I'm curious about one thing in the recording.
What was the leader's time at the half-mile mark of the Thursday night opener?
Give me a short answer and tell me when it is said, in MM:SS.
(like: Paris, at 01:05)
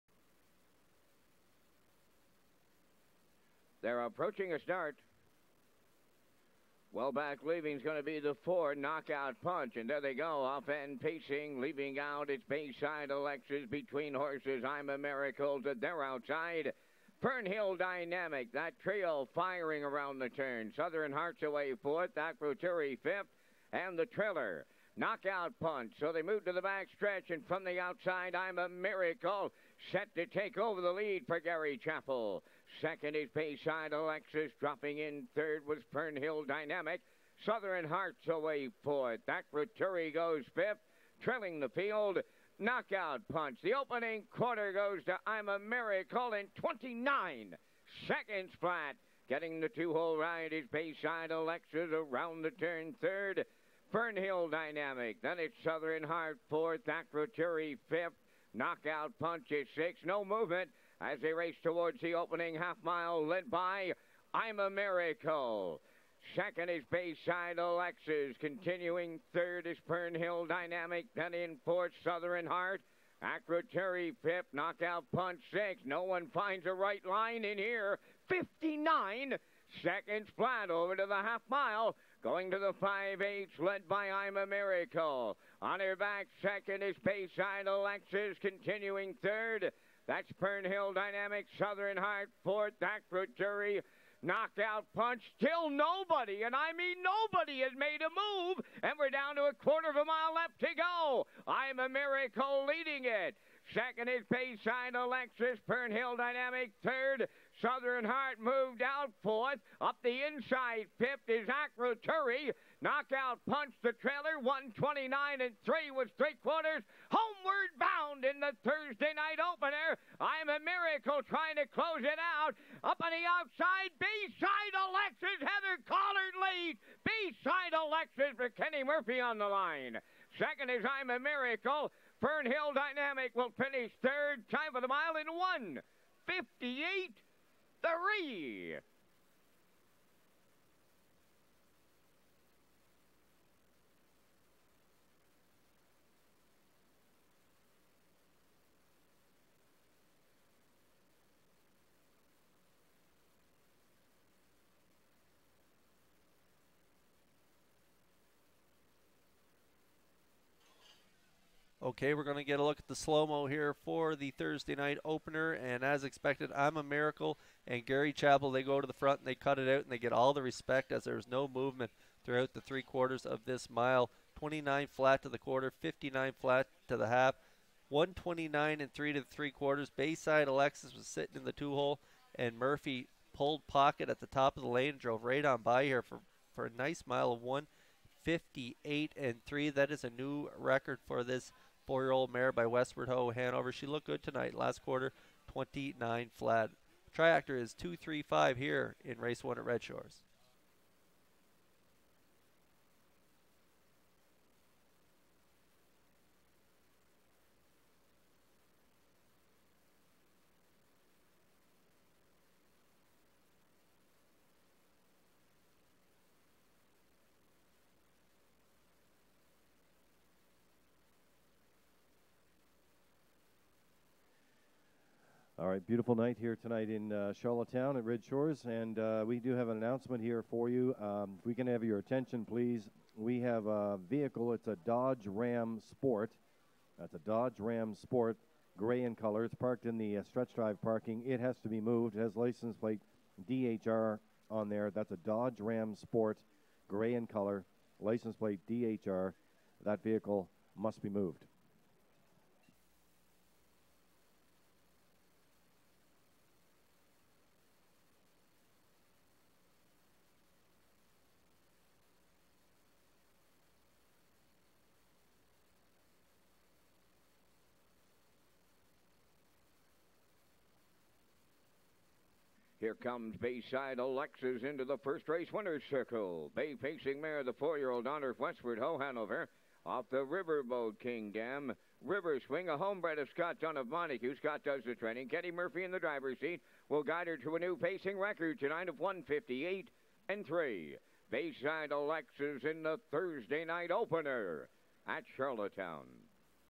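59 seconds, at 01:18.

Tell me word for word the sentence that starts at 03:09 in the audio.
That is a new record for this Four-year-old mare by Westward Ho, Hanover.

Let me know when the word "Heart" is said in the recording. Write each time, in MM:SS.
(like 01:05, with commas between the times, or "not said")
00:21, 00:37, 00:56, 01:12, 01:31, 01:48.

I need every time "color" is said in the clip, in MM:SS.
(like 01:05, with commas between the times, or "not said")
03:59, 04:07.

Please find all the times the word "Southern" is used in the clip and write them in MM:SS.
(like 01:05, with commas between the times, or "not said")
00:20, 00:37, 00:55, 01:12, 01:31, 01:47.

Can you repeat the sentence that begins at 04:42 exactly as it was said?
River swing, a homebred of Scott, John of Montague.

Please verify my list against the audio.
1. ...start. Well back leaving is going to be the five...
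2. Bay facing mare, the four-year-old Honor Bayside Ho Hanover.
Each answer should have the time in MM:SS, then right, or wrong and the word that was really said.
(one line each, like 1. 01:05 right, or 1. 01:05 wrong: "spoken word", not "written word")
1. 00:04 wrong: "four", not "five"
2. 04:36 wrong: "Westward", not "Bayside".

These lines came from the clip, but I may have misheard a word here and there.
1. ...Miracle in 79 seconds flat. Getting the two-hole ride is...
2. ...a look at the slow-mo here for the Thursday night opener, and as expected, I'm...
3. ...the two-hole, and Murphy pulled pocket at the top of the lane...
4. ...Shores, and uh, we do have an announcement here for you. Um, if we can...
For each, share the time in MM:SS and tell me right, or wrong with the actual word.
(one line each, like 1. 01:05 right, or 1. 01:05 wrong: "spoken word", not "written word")
1. 00:45 wrong: "29", not "79"
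2. 02:42 right
3. 03:01 right
4. 03:48 right.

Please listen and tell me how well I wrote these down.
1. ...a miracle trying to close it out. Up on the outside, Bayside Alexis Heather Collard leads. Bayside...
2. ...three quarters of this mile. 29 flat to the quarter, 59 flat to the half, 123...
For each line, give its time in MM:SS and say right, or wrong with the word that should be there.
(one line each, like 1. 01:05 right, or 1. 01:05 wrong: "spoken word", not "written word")
1. 02:00 right
2. 02:52 wrong: "129", not "123".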